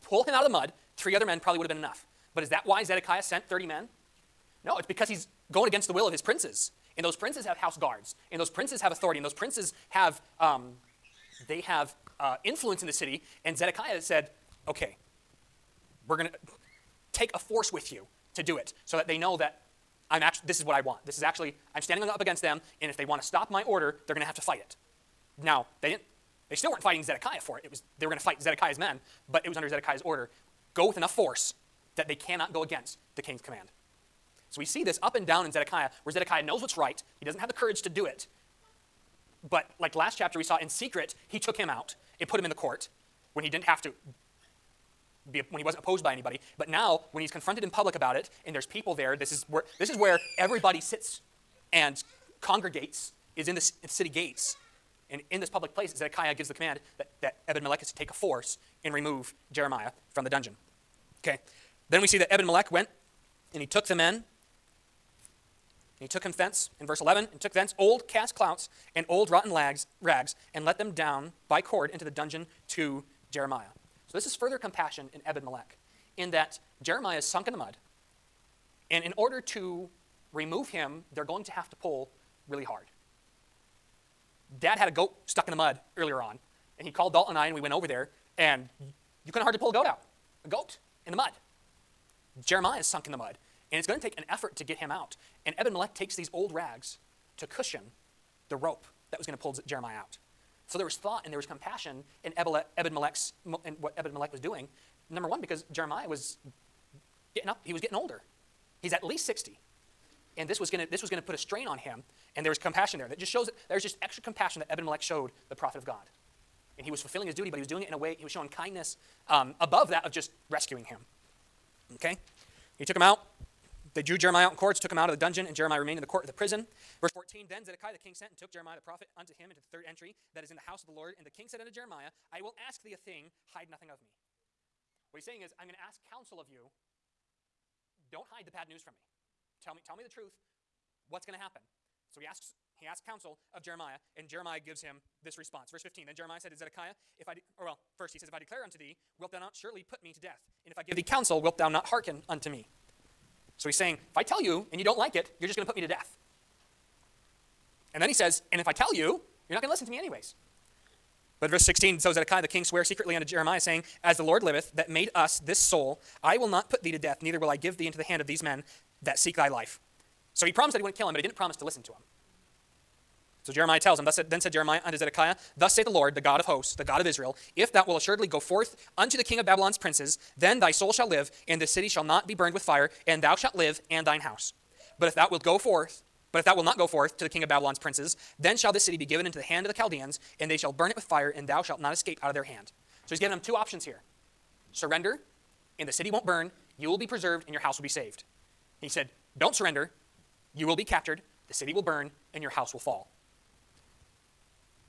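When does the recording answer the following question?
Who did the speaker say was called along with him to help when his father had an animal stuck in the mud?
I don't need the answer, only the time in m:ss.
1:27.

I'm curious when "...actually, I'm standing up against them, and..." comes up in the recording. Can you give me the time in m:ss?
0:21.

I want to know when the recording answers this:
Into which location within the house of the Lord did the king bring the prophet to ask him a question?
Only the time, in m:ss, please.
2:09.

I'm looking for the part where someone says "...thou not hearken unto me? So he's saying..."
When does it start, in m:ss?
2:31.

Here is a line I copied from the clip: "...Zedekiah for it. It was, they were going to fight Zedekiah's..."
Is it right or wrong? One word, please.
right.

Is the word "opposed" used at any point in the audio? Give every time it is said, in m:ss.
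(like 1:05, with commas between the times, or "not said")
0:45.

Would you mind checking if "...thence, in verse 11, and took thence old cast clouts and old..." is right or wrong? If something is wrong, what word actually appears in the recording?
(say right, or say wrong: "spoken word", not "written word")
right.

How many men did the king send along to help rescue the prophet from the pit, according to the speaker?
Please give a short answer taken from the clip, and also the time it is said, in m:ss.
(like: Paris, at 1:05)
30, at 0:03.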